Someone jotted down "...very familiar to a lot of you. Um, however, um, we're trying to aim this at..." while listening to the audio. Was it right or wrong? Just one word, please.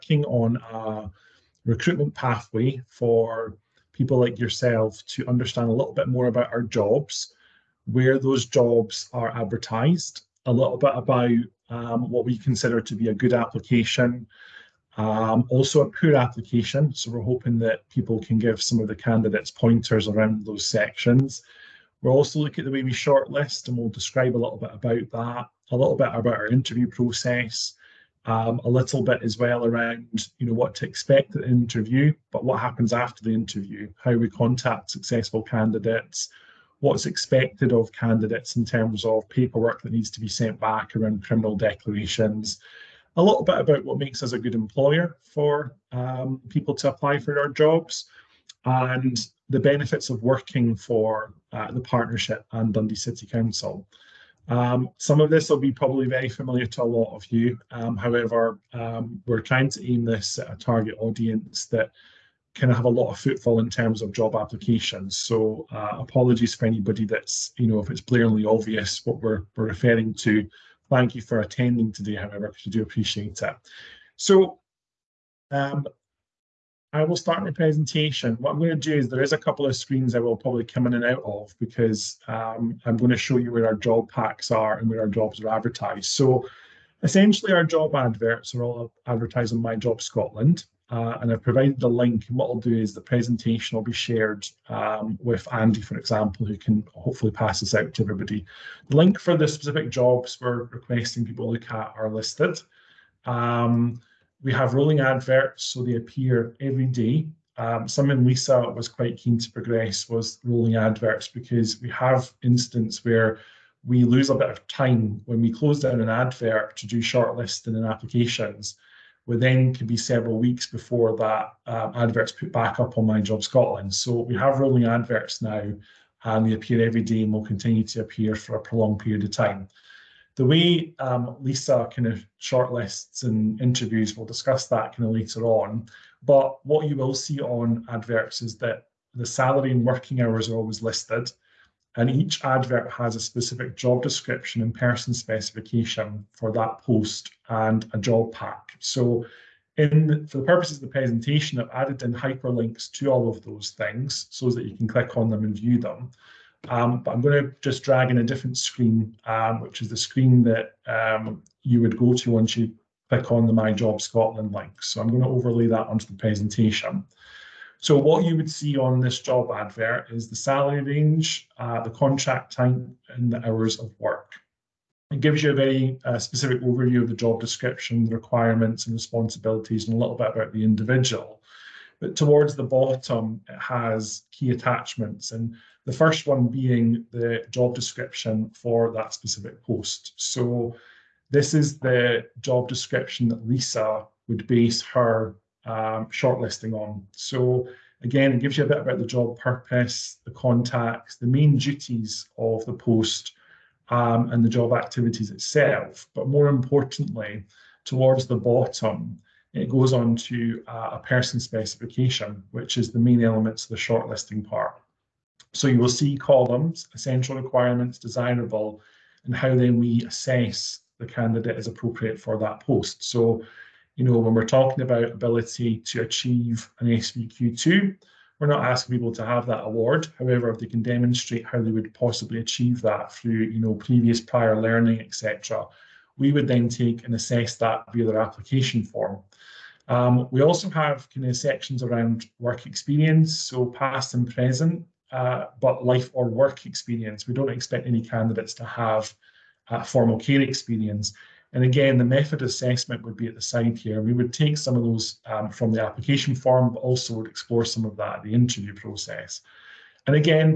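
right.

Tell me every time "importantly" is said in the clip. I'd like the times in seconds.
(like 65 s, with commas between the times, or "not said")
206 s.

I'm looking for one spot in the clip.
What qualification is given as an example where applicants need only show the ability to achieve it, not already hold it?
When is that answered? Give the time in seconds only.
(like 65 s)
226 s.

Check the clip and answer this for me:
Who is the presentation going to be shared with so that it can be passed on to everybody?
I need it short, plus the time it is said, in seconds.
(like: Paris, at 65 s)
Andy, at 95 s.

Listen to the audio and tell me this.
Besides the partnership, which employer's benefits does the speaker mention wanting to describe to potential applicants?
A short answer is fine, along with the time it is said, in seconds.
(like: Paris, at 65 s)
Dundee City Council, at 52 s.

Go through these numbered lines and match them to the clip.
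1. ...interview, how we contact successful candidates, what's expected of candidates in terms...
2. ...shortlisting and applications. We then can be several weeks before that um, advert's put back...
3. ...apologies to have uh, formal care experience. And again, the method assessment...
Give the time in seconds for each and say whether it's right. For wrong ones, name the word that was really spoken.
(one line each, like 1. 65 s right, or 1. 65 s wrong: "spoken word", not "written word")
1. 33 s right
2. 116 s right
3. 248 s wrong: "candidates", not "apologies".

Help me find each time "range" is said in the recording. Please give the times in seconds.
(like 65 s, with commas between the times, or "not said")
170 s.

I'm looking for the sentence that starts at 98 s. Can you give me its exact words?
The link for the specific jobs we're requesting people look at are listed.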